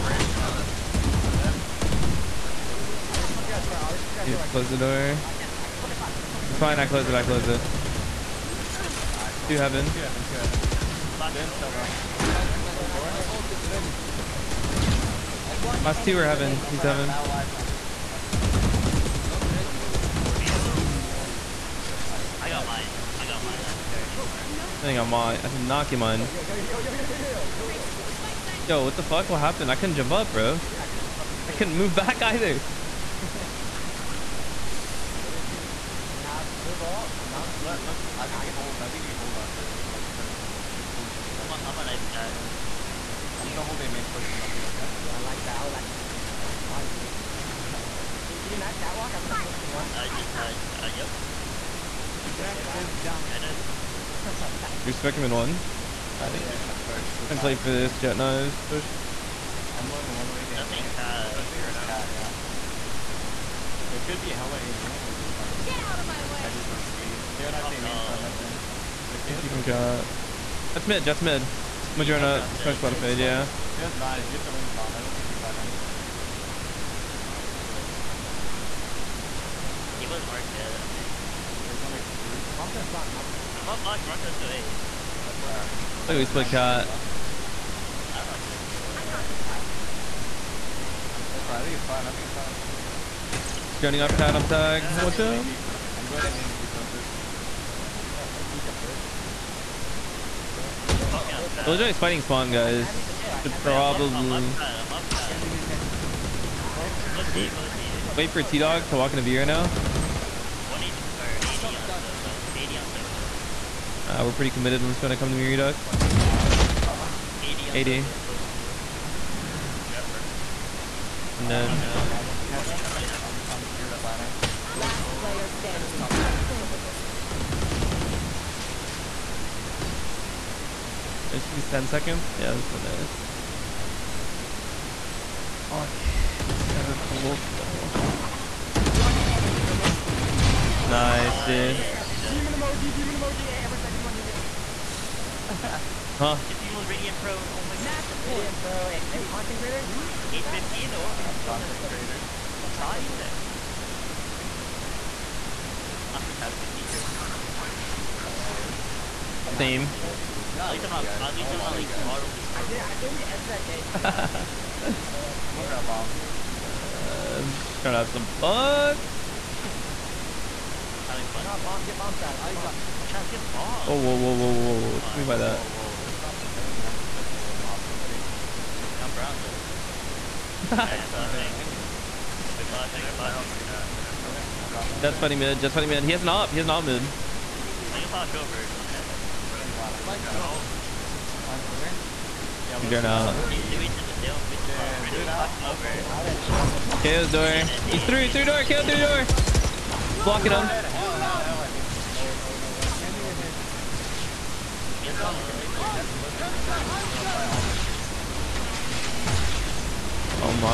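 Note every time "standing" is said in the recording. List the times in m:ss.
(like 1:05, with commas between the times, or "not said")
2:05.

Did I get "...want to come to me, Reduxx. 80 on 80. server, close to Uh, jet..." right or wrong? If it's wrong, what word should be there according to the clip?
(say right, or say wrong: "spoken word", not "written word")
right.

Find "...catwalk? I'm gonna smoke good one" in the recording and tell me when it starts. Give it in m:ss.
0:48.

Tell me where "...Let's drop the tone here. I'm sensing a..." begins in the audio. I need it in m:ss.
2:56.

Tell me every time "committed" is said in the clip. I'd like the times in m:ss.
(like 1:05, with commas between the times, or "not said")
1:54.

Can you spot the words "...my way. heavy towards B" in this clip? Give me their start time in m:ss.
1:06.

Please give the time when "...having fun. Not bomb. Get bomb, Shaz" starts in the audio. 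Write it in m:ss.
2:51.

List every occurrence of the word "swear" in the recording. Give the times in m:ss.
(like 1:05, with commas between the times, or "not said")
not said.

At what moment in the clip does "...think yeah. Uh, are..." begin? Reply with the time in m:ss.
0:56.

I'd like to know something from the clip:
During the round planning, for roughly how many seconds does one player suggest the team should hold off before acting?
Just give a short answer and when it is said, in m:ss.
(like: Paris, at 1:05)
15, 20 seconds, at 0:40.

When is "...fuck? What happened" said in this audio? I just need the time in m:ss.
0:29.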